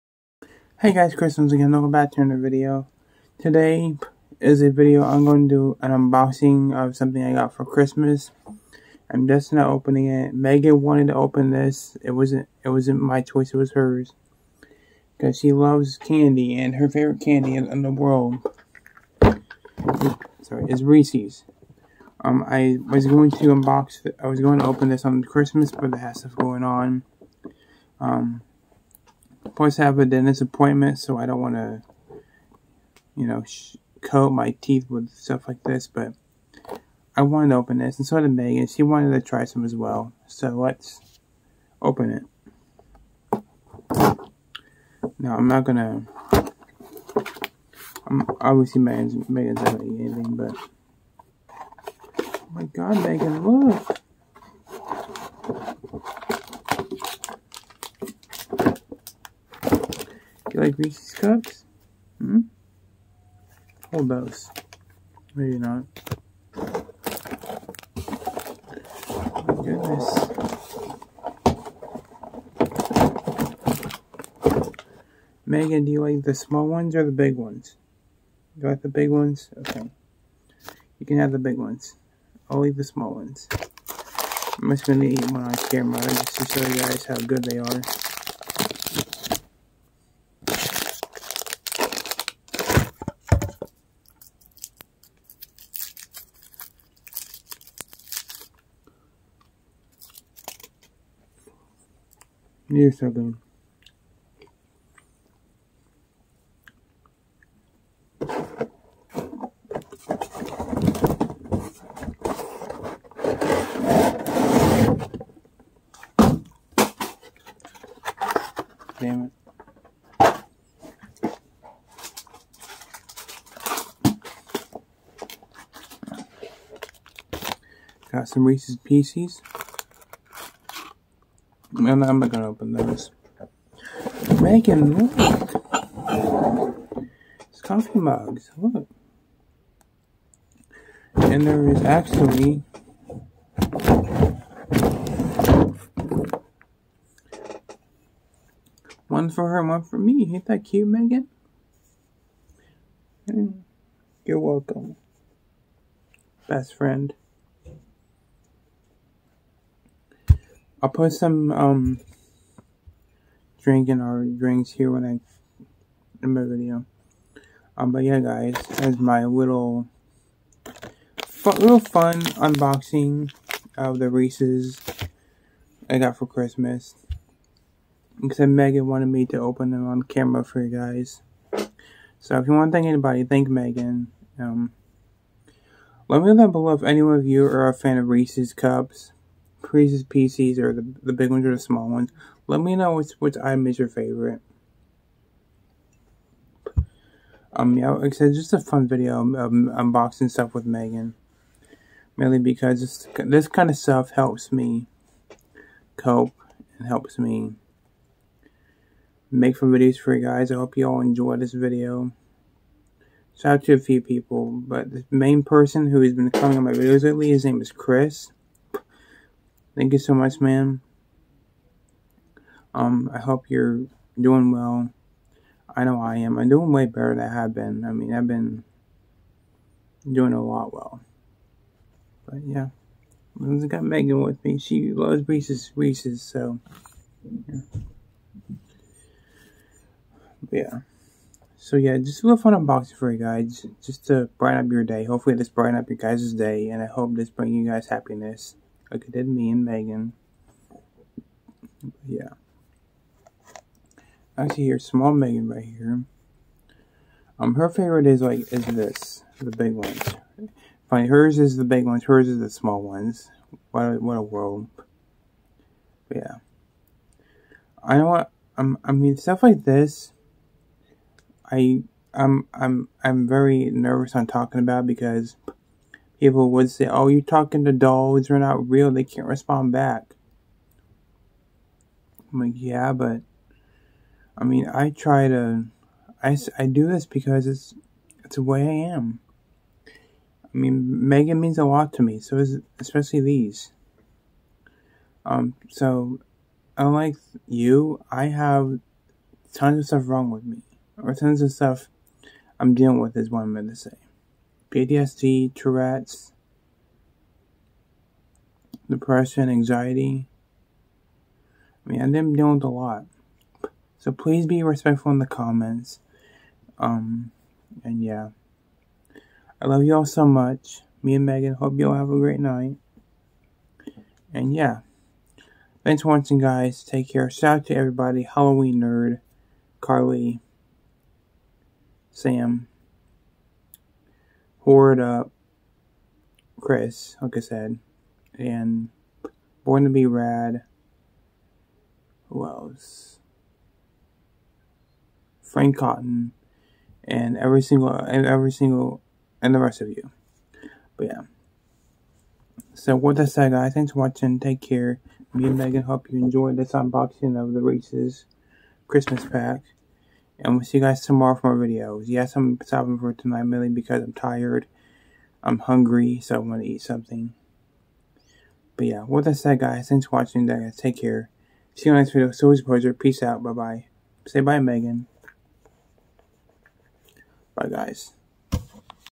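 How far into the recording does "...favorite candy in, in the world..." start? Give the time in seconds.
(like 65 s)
16 s.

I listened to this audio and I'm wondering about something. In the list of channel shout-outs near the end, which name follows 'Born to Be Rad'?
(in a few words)
Frank Cotton.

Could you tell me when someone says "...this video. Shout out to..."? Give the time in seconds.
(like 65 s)
211 s.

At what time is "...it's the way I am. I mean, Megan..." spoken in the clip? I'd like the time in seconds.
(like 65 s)
288 s.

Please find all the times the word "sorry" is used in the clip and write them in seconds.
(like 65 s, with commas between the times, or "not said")
20 s.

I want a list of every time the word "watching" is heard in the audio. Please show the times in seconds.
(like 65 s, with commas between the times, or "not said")
326 s, 353 s, 370 s.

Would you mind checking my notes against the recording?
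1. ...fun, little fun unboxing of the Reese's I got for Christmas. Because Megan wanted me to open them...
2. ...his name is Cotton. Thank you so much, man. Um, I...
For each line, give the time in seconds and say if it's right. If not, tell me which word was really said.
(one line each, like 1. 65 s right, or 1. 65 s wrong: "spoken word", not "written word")
1. 171 s right
2. 217 s wrong: "Chris", not "Cotton".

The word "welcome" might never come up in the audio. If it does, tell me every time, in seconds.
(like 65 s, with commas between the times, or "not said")
1 s, 154 s.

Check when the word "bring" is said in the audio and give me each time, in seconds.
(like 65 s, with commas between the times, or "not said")
247 s.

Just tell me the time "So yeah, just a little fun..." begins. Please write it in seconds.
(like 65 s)
241 s.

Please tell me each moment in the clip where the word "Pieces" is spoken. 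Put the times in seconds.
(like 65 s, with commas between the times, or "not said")
128 s, 190 s.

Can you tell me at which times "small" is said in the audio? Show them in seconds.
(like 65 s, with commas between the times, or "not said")
76 s, 82 s, 191 s, 254 s, 262 s.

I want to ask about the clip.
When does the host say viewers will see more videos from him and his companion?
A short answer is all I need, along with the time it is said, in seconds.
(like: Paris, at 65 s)
Tomorrow, at 361 s.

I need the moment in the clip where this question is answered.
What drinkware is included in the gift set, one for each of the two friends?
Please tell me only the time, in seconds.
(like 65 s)
137 s.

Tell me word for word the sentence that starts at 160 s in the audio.
I'll put some um drinking or drinks here when I in my video.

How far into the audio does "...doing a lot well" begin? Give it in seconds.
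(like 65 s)
230 s.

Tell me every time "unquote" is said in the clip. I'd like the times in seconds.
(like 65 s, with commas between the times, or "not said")
not said.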